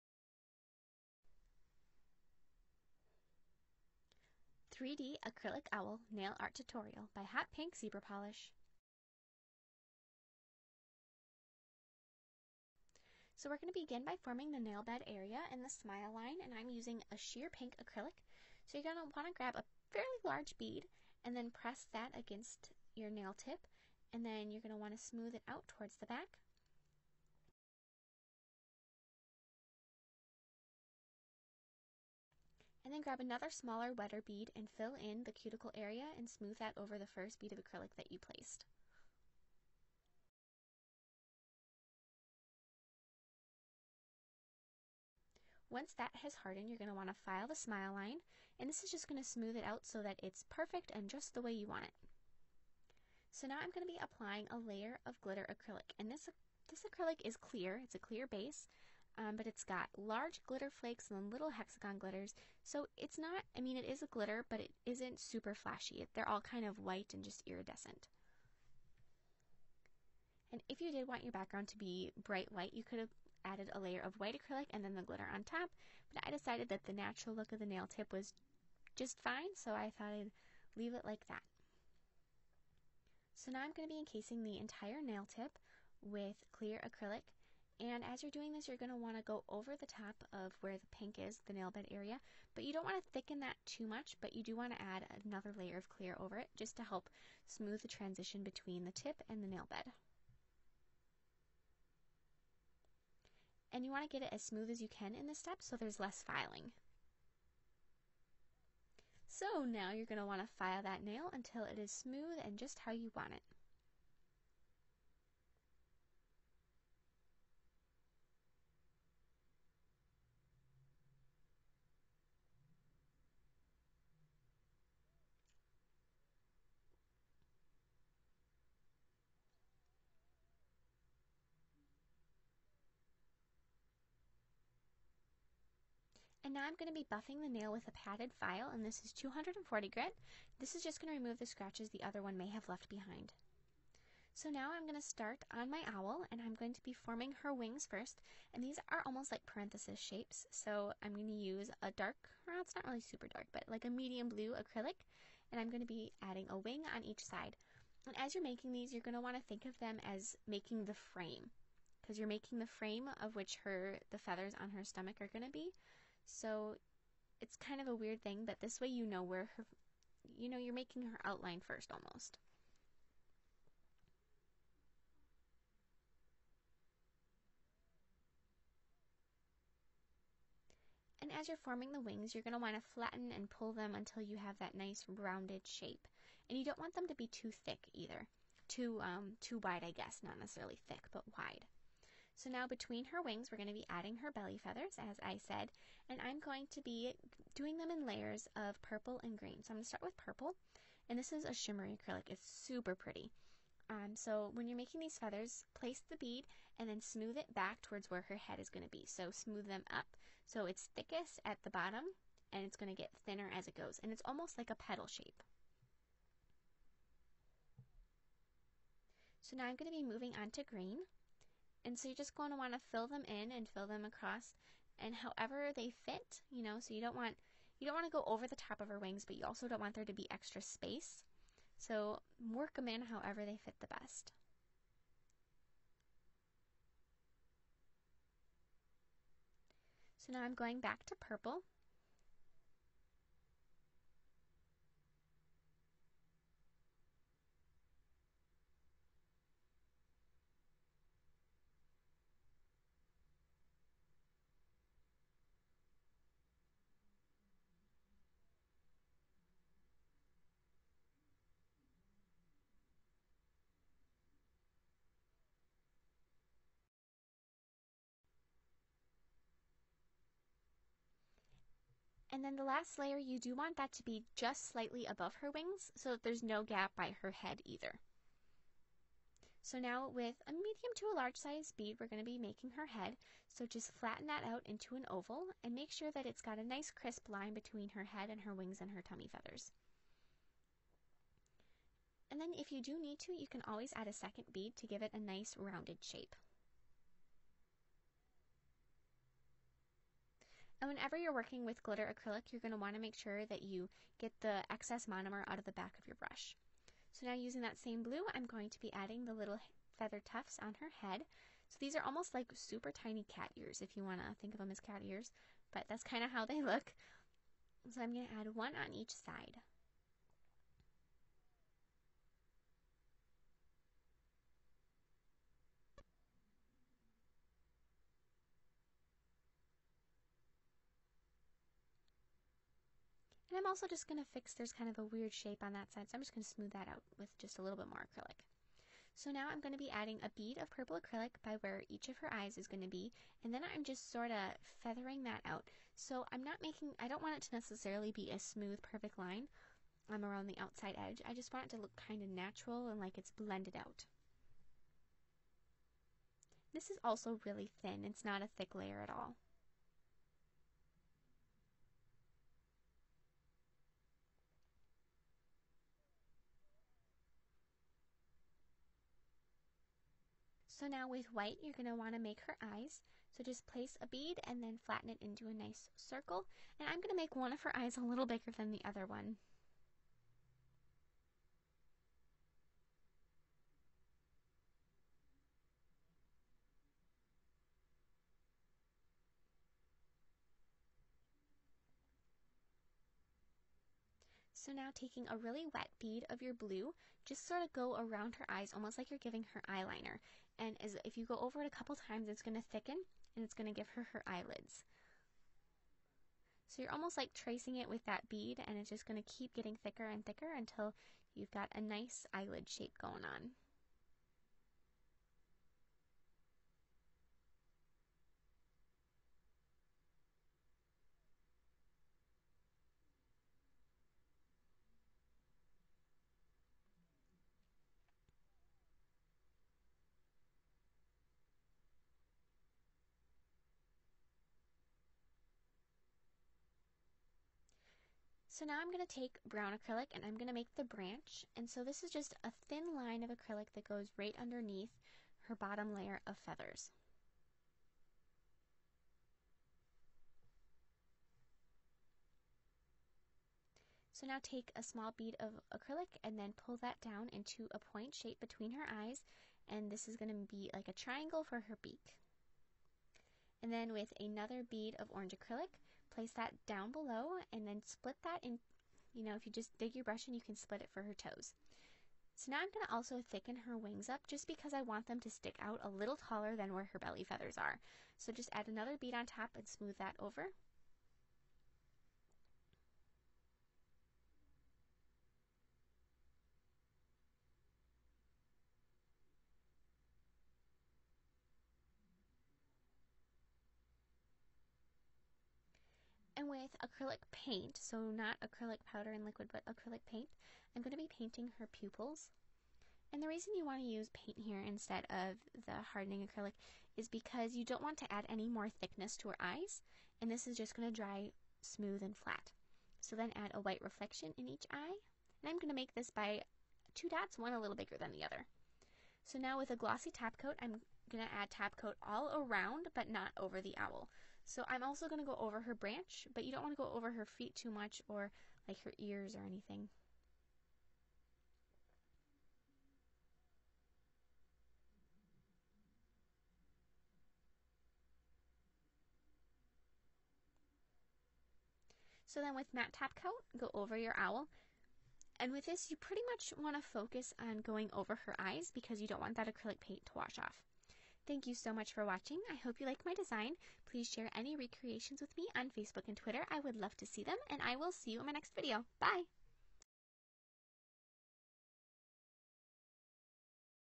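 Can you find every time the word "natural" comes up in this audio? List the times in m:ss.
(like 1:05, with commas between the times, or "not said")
1:16, 5:52.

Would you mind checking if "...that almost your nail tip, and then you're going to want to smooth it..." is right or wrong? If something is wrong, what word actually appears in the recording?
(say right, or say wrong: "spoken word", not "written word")
wrong: "against", not "almost".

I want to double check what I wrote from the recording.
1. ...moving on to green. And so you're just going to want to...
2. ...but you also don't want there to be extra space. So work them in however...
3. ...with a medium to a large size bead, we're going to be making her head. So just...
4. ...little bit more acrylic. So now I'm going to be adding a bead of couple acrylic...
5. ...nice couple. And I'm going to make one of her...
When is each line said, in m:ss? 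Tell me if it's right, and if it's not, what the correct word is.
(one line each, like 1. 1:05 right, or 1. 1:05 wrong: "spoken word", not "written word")
1. 3:40 right
2. 3:49 right
3. 4:40 right
4. 5:37 wrong: "purple", not "couple"
5. 6:15 wrong: "circle", not "couple".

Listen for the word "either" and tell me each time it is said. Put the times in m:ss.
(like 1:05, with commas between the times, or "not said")
3:07, 4:37.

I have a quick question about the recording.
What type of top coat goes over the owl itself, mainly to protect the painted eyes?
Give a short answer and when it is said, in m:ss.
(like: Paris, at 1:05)
Matte top coat, at 9:02.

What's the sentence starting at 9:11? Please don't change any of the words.
Thank you so much for watching.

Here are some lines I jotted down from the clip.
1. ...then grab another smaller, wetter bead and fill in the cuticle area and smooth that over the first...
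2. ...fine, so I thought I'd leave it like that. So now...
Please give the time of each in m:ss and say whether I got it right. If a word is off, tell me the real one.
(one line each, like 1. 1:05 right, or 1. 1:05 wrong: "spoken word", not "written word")
1. 0:32 right
2. 1:19 right.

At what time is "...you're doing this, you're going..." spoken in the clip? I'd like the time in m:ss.
1:28.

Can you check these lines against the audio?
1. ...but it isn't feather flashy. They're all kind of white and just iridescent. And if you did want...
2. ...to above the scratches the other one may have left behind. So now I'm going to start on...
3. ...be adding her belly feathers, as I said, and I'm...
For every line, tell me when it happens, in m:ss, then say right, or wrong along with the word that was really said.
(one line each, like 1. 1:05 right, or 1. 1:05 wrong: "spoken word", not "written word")
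1. 1:04 wrong: "super", not "feather"
2. 2:21 wrong: "remove", not "above"
3. 3:13 right.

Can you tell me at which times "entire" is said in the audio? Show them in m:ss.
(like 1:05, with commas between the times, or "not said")
1:24.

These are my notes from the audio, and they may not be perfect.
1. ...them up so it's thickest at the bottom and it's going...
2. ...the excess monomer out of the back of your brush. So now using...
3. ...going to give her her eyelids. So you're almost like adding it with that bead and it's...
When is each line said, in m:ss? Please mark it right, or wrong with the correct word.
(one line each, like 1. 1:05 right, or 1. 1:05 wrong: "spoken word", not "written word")
1. 3:29 right
2. 5:04 right
3. 6:43 wrong: "tracing", not "adding".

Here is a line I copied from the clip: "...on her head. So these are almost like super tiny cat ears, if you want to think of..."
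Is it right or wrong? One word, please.
right.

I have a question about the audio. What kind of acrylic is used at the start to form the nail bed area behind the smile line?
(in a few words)
Sheer pink acrylic.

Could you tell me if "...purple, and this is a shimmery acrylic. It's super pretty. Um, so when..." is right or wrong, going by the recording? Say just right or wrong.
right.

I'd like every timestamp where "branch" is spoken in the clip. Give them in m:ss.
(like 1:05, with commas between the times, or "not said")
7:20, 8:45.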